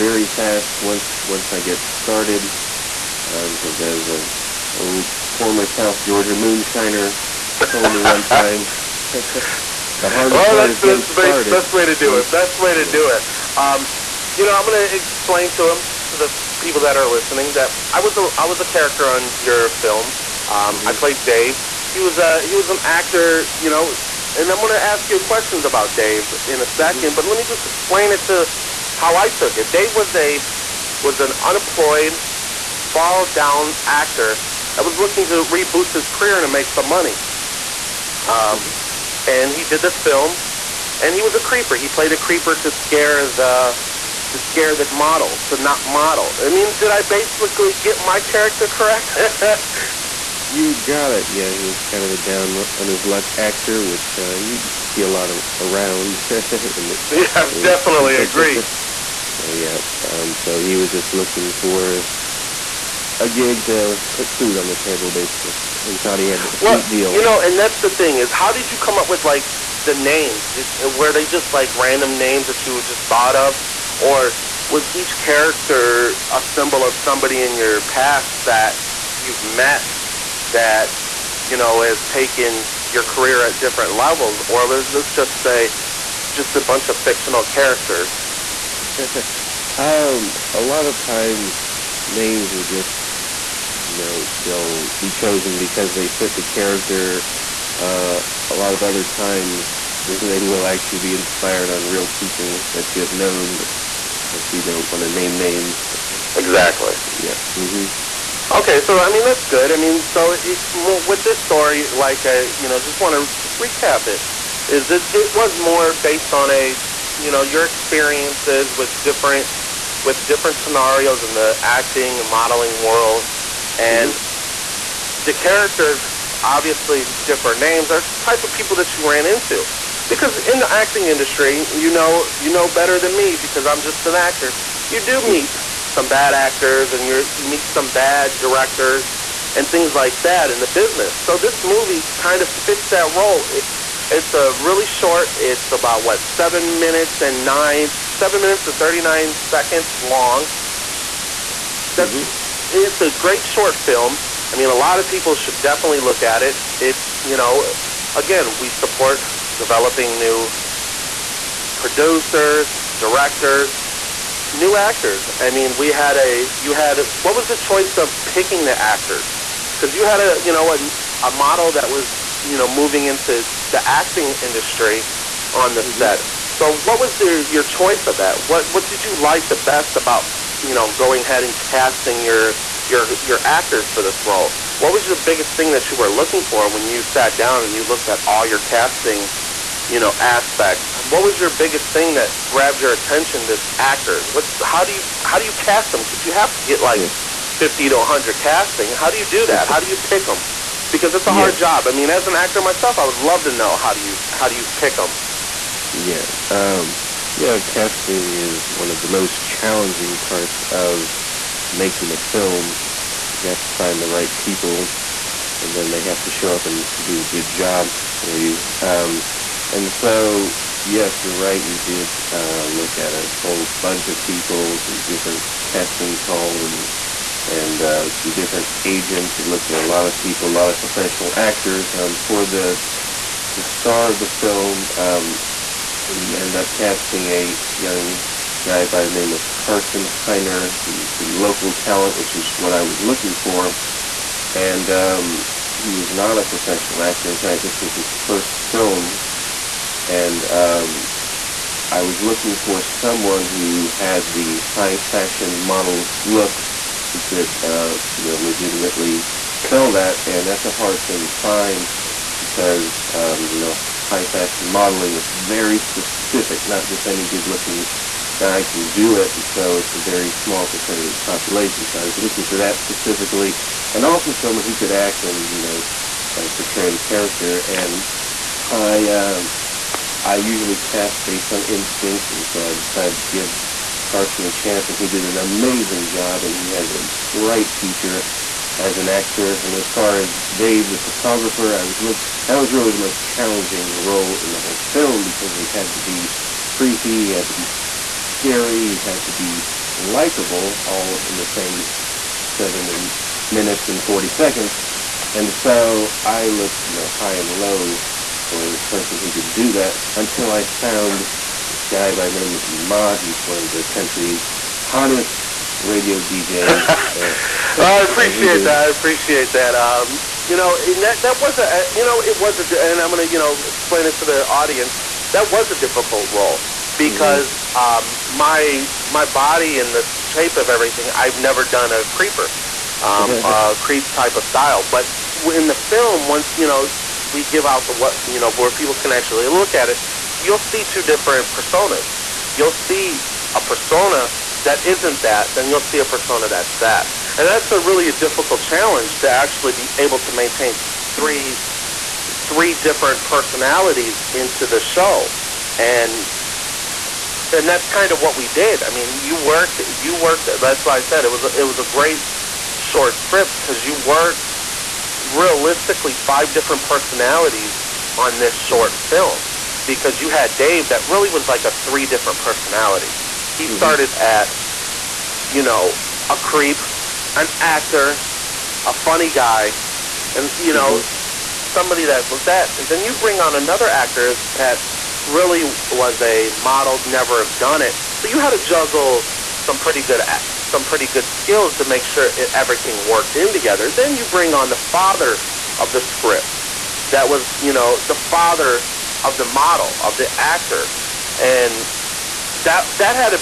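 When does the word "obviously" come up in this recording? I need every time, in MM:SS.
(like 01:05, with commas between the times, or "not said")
01:44, 02:06.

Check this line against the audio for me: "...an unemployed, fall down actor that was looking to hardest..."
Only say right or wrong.
wrong.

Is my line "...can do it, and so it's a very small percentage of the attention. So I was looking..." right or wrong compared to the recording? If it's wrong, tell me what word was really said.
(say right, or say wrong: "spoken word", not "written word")
wrong: "population", not "attention".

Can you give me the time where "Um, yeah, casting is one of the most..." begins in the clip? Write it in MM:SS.
03:26.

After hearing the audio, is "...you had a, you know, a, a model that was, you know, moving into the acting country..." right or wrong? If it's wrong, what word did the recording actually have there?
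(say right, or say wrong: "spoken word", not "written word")
wrong: "industry", not "country".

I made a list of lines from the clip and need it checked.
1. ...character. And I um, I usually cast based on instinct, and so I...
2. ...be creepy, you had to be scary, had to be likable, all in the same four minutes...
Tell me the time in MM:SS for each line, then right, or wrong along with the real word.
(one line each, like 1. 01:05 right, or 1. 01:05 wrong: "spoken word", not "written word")
1. 04:36 right
2. 04:56 wrong: "seven", not "four".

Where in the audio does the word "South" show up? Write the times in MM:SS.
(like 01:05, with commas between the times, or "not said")
00:05.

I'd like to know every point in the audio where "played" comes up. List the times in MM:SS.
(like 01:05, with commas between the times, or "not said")
00:20, 00:41.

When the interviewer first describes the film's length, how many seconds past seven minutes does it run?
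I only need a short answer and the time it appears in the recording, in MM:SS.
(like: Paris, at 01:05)
39, at 02:28.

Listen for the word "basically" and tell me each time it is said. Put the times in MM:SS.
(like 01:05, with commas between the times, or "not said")
00:47, 01:05.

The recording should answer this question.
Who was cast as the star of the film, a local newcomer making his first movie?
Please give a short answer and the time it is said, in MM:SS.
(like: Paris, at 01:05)
Carson Heiner, at 03:59.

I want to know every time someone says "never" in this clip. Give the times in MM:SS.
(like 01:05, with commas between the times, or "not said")
05:31, 06:27.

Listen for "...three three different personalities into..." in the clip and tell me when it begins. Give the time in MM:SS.
05:51.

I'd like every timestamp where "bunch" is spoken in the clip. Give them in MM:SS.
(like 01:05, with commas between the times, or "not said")
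01:26, 03:43.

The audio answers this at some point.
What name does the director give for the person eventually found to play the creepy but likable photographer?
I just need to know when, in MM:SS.
05:12.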